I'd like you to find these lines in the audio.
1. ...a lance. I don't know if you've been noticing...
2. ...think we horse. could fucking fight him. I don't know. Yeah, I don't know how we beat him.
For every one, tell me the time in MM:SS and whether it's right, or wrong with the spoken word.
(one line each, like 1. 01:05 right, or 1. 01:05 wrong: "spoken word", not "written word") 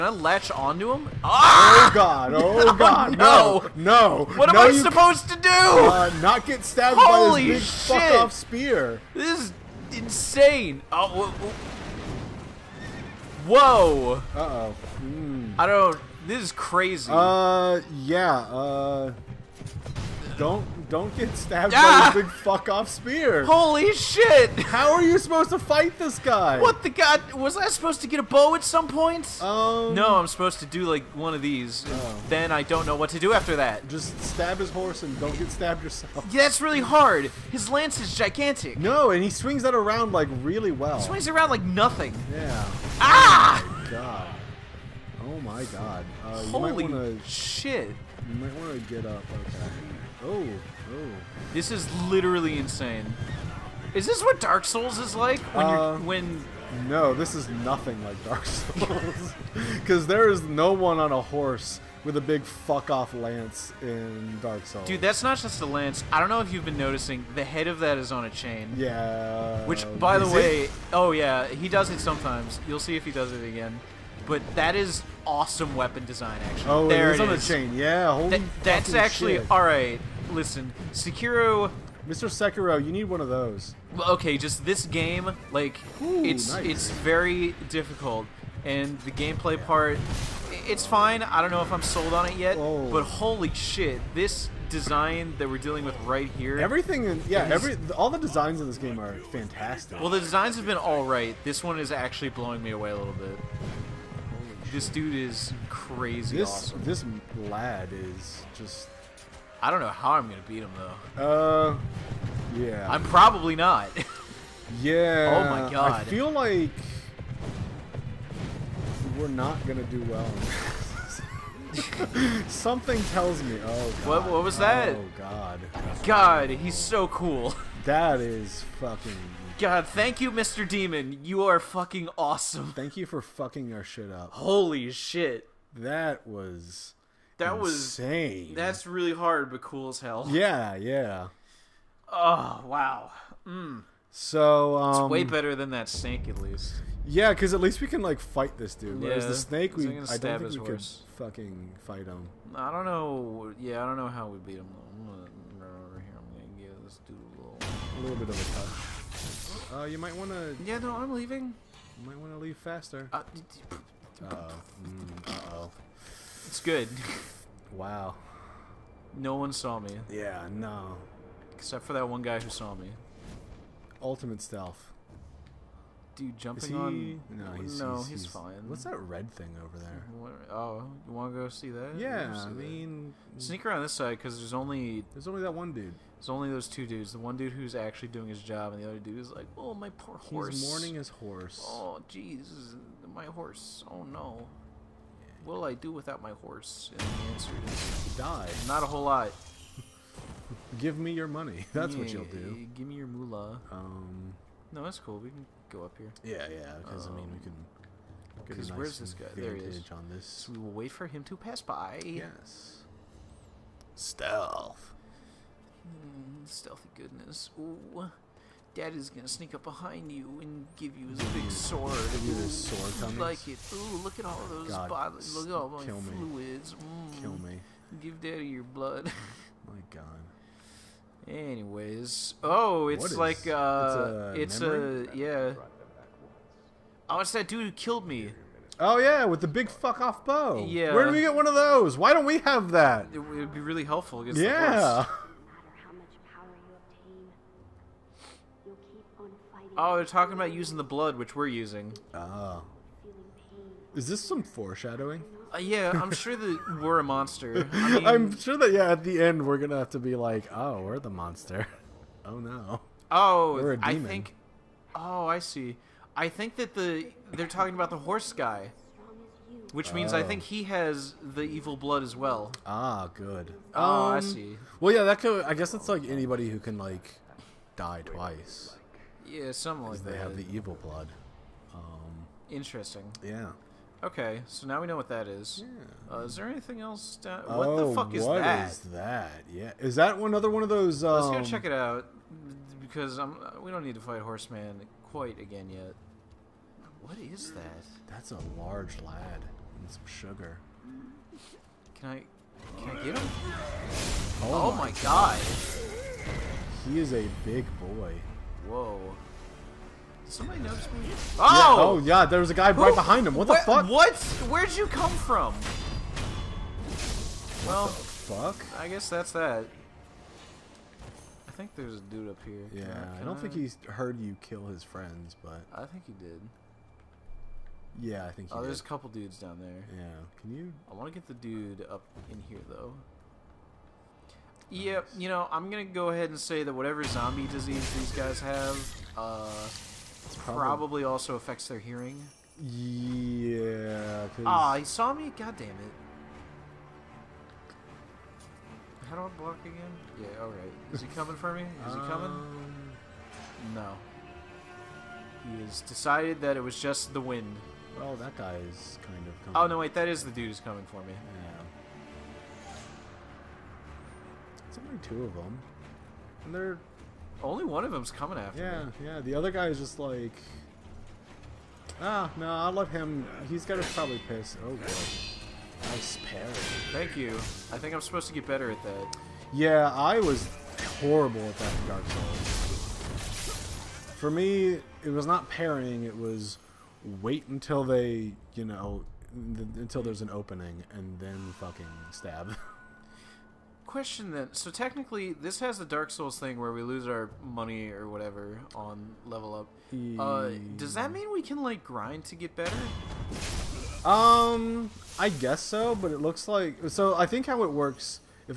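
1. 01:05 right
2. 02:30 right.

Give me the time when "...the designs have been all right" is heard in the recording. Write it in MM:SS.
01:40.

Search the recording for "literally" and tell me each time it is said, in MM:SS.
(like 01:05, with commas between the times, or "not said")
00:52.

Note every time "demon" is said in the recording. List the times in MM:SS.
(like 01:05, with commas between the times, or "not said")
02:10, 04:23.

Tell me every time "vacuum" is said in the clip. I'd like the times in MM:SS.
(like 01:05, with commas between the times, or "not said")
not said.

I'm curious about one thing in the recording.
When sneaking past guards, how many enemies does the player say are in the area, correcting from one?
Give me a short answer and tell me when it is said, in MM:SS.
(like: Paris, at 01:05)
2, at 03:06.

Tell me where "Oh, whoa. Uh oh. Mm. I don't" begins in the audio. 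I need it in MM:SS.
00:10.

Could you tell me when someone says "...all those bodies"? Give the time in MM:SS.
03:44.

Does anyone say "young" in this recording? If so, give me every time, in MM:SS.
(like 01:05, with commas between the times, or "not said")
not said.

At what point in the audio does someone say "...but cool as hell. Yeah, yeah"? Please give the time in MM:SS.
02:19.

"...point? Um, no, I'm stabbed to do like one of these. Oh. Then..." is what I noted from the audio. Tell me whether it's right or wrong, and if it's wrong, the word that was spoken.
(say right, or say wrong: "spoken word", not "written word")
wrong: "supposed", not "stabbed".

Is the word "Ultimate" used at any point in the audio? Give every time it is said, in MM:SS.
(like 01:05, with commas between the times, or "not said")
02:54.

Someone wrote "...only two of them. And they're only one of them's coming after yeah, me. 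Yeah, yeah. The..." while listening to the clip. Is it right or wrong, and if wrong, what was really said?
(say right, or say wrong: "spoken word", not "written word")
right.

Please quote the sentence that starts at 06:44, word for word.
Um, I guess so, but it looks like so.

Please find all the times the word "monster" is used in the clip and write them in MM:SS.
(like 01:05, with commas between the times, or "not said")
04:17, 04:21.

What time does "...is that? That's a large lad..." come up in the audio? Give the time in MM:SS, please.
04:57.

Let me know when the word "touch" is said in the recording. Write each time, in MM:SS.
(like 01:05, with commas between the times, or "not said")
02:38.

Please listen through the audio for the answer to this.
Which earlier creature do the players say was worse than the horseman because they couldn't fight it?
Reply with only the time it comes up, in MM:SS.
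02:25.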